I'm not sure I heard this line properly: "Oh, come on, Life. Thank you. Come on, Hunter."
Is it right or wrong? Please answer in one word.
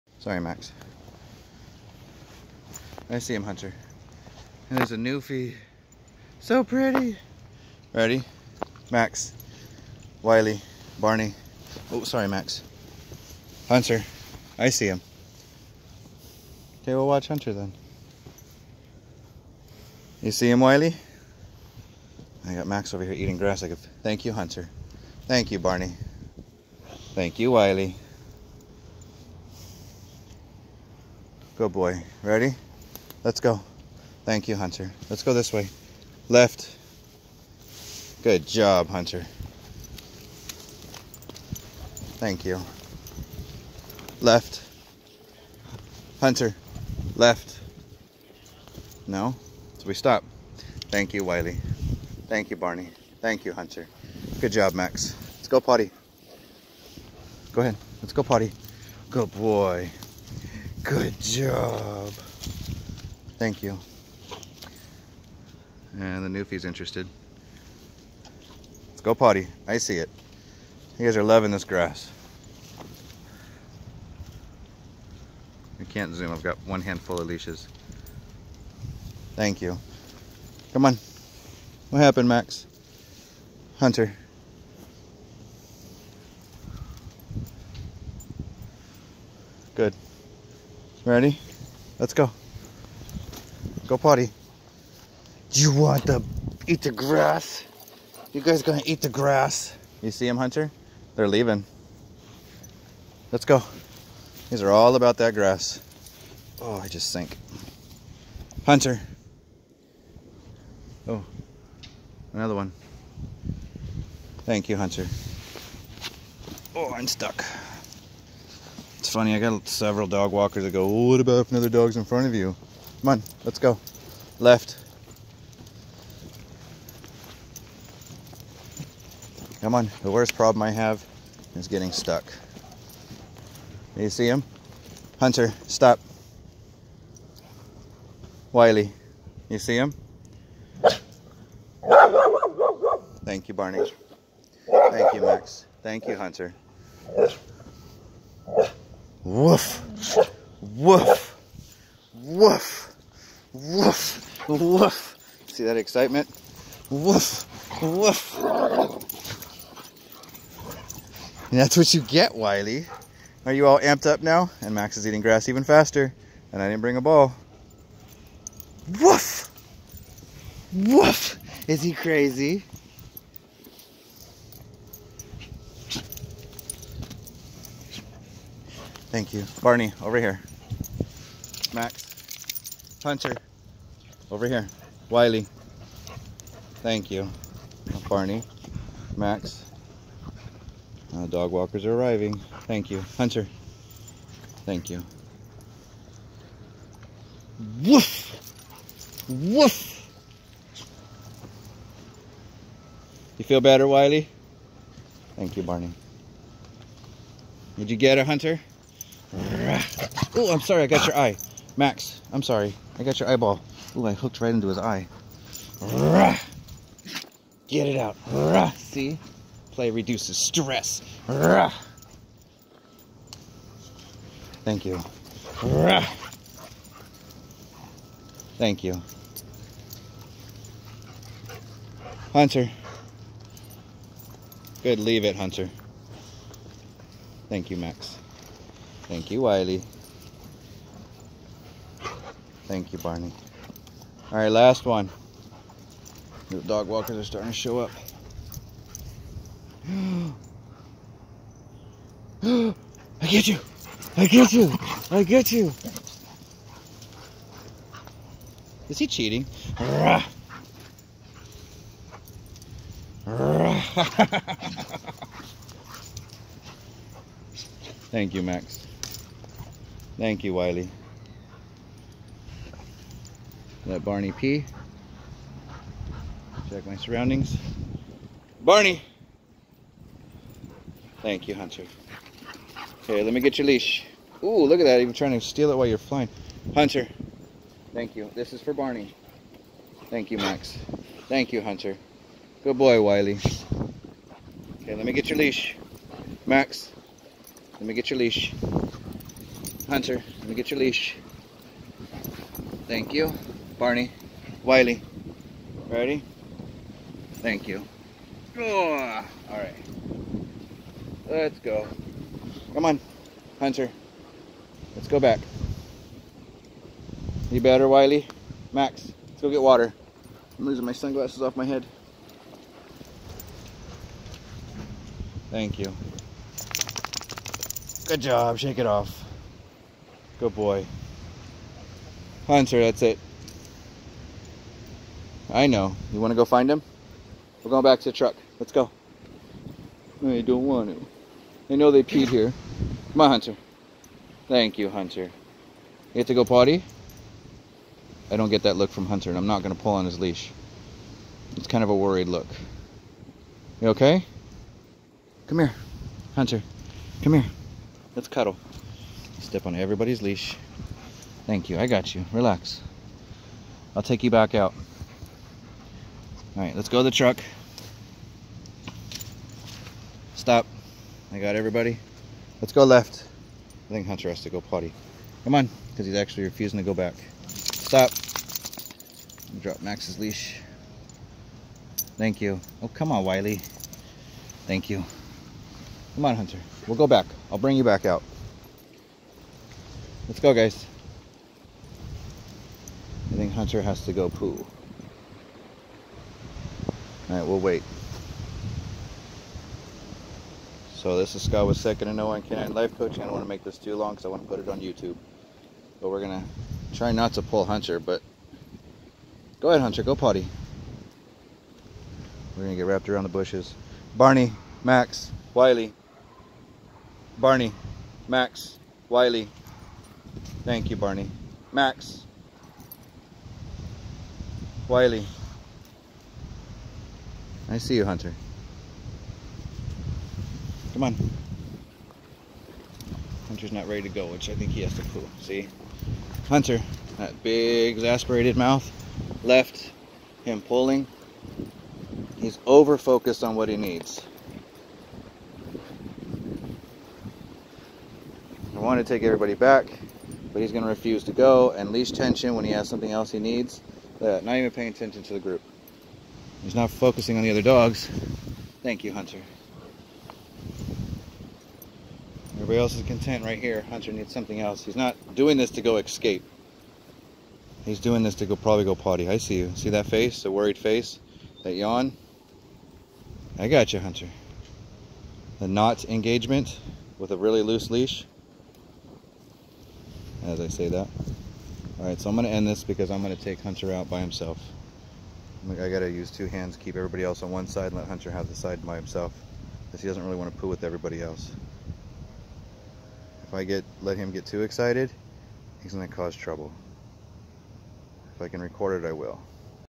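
wrong.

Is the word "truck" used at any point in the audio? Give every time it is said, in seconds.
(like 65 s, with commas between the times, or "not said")
338 s, 367 s.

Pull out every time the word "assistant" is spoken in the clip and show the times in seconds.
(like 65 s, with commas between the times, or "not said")
not said.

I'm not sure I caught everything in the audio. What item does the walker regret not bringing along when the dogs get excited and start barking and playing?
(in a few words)
a ball.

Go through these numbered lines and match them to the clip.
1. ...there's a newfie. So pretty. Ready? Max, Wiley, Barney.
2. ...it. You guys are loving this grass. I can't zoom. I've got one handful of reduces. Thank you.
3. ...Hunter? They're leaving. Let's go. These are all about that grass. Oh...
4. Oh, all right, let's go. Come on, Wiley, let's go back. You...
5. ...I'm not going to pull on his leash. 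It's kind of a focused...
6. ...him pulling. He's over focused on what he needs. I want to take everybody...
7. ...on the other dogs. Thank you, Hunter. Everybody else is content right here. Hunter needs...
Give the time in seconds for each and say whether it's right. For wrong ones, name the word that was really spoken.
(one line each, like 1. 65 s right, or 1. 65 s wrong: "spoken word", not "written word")
1. 4 s right
2. 69 s wrong: "leashes", not "reduces"
3. 100 s right
4. 308 s wrong: "Hunter", not "Wiley"
5. 349 s wrong: "worried", not "focused"
6. 440 s right
7. 457 s right.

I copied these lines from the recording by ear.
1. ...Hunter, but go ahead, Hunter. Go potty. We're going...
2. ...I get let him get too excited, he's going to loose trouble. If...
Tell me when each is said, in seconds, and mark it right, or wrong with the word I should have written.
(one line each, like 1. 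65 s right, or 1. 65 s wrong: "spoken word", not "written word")
1. 407 s right
2. 493 s wrong: "cause", not "loose".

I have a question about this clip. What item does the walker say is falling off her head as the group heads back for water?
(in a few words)
sunglasses.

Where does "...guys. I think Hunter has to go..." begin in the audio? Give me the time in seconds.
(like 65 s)
390 s.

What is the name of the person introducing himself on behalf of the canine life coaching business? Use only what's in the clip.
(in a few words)
Scott.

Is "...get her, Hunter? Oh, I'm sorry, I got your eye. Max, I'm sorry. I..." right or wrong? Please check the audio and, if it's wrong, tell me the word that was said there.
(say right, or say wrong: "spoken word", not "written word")
right.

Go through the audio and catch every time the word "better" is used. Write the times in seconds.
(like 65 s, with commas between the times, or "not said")
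203 s, 317 s.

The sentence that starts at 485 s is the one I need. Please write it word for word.
I got to use two hands, keep everybody else on one side, and let Hunter have the side by himself.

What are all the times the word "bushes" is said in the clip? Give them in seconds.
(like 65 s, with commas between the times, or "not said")
413 s.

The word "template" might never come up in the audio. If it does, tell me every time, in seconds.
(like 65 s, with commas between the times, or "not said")
not said.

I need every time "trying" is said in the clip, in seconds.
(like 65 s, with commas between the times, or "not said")
285 s.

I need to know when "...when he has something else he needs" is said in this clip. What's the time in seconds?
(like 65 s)
452 s.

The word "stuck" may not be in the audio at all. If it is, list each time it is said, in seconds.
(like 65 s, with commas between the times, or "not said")
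117 s, 131 s.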